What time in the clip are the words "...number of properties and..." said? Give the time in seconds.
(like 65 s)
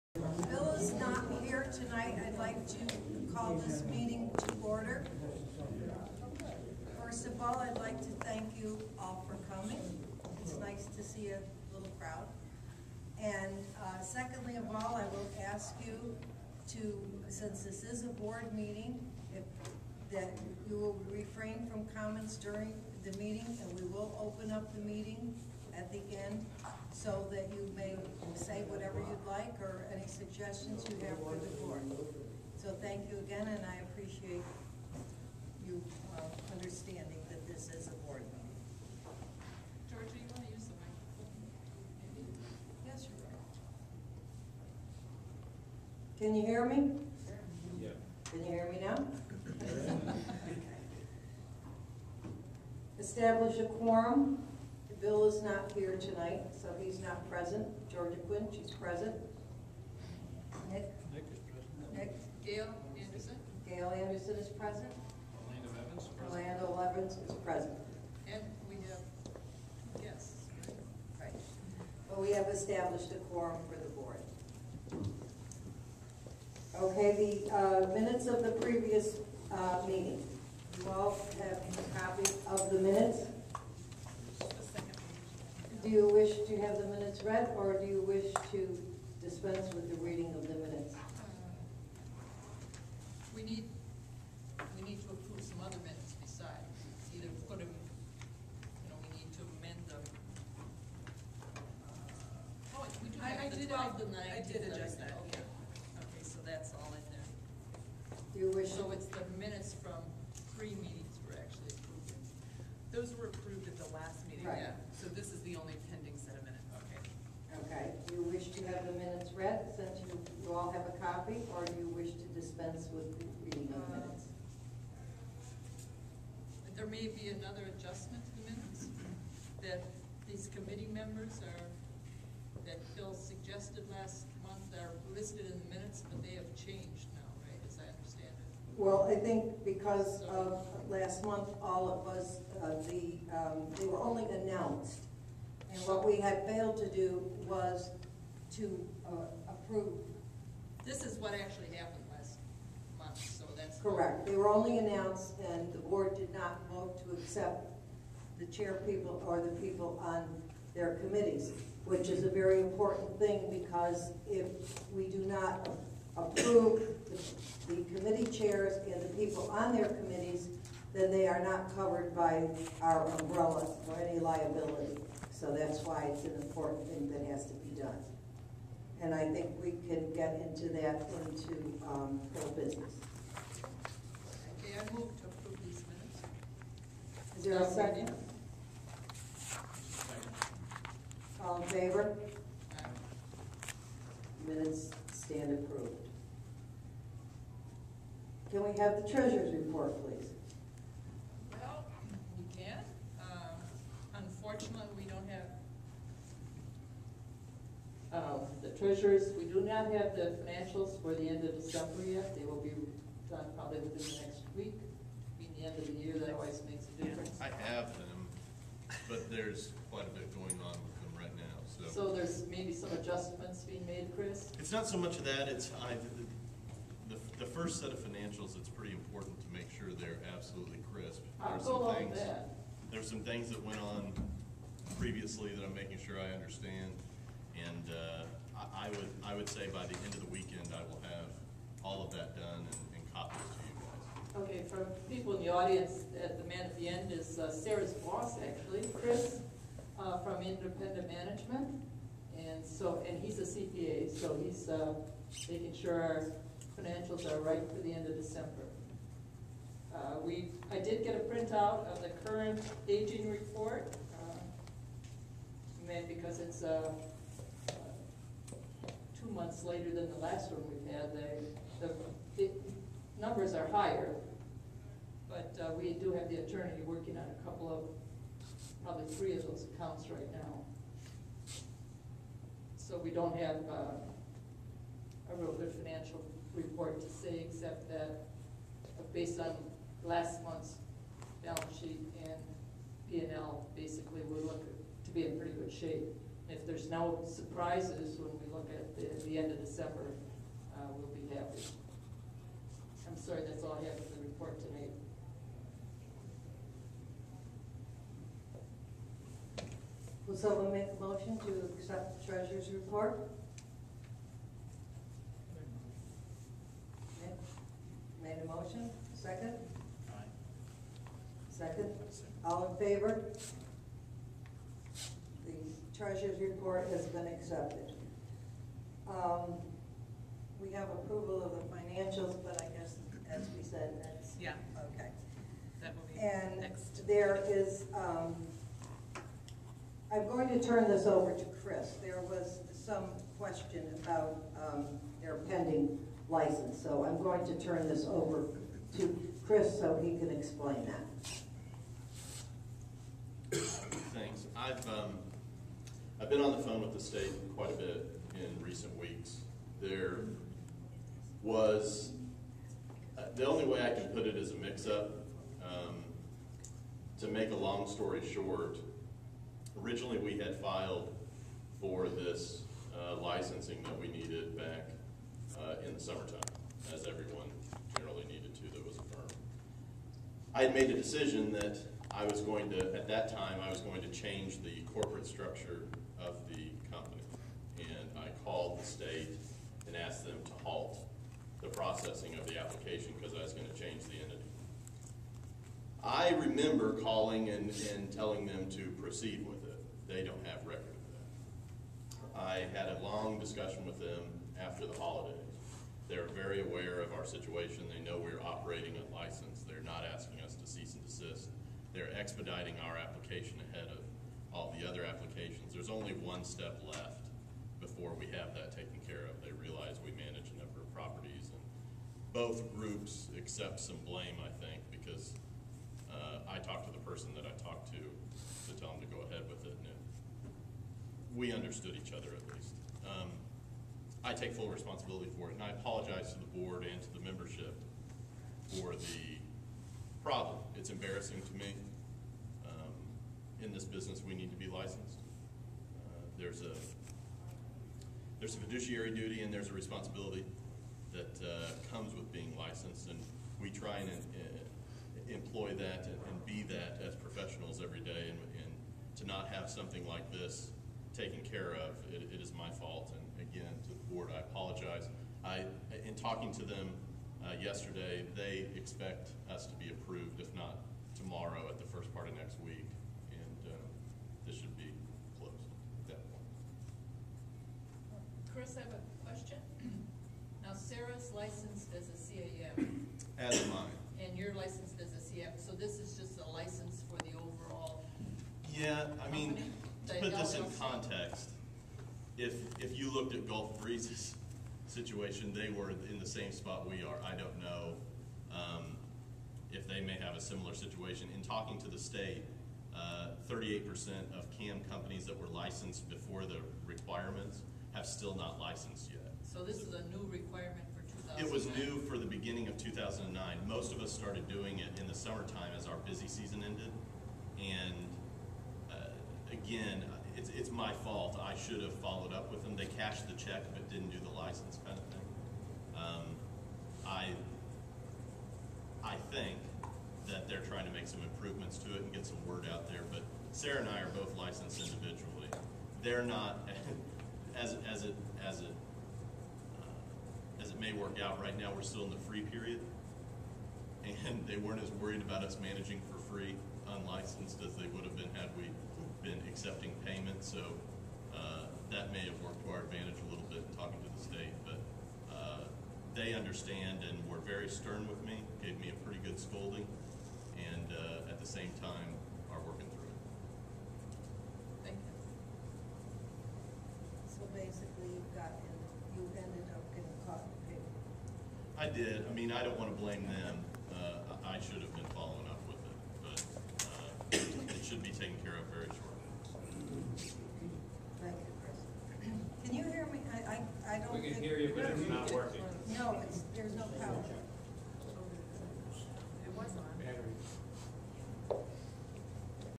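420 s.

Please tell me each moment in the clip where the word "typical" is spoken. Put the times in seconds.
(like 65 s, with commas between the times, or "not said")
not said.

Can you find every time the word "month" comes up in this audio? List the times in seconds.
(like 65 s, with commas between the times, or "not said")
134 s, 141 s, 152 s, 269 s, 290 s.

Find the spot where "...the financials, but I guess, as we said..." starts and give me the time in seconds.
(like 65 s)
331 s.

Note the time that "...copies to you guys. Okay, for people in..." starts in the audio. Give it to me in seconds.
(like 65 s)
243 s.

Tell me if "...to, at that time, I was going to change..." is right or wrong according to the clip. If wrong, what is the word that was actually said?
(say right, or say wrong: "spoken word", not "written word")
right.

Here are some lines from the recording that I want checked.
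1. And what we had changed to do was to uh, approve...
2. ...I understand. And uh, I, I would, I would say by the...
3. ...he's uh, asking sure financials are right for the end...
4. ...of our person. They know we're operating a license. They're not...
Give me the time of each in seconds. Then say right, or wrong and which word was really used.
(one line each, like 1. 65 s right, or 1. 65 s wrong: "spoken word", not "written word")
1. 145 s wrong: "failed", not "changed"
2. 236 s right
3. 254 s wrong: "making", not "asking"
4. 406 s wrong: "situation", not "person".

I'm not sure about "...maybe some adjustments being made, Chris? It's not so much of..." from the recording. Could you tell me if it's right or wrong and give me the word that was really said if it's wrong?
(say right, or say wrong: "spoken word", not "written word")
right.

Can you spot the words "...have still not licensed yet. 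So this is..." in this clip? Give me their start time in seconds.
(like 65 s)
507 s.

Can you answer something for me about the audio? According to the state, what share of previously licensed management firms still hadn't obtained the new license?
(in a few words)
38%.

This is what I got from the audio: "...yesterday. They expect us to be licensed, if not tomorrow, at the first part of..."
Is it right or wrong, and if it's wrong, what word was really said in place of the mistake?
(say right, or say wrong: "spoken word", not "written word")
wrong: "approved", not "licensed".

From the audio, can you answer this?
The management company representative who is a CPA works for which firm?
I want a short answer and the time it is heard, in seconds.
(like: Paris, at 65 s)
Independent Management, at 250 s.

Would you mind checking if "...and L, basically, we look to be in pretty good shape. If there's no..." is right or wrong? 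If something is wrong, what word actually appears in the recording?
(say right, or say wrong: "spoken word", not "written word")
right.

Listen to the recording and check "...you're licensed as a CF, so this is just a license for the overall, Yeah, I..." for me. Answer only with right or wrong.
right.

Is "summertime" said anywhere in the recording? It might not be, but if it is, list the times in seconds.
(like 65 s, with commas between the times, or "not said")
375 s, 515 s.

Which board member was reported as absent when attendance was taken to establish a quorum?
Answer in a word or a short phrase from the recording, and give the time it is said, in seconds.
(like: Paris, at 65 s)
Bill, at 55 s.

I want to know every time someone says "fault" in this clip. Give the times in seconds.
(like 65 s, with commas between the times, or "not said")
462 s, 521 s.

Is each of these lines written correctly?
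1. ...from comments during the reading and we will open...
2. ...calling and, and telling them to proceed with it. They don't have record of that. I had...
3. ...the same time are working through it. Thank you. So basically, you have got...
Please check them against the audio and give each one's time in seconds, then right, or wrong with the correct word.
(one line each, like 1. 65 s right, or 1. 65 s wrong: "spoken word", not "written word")
1. 21 s wrong: "meeting", not "reading"
2. 396 s right
3. 561 s right.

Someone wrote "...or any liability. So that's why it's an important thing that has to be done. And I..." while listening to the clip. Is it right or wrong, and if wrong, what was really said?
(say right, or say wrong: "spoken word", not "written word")
right.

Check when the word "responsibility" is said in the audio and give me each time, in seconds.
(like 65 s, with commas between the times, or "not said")
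434 s, 449 s.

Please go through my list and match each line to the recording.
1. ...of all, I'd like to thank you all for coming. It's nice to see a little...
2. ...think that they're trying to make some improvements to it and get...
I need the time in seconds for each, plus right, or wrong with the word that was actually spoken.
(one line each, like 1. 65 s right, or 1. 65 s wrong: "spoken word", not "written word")
1. 7 s right
2. 529 s right.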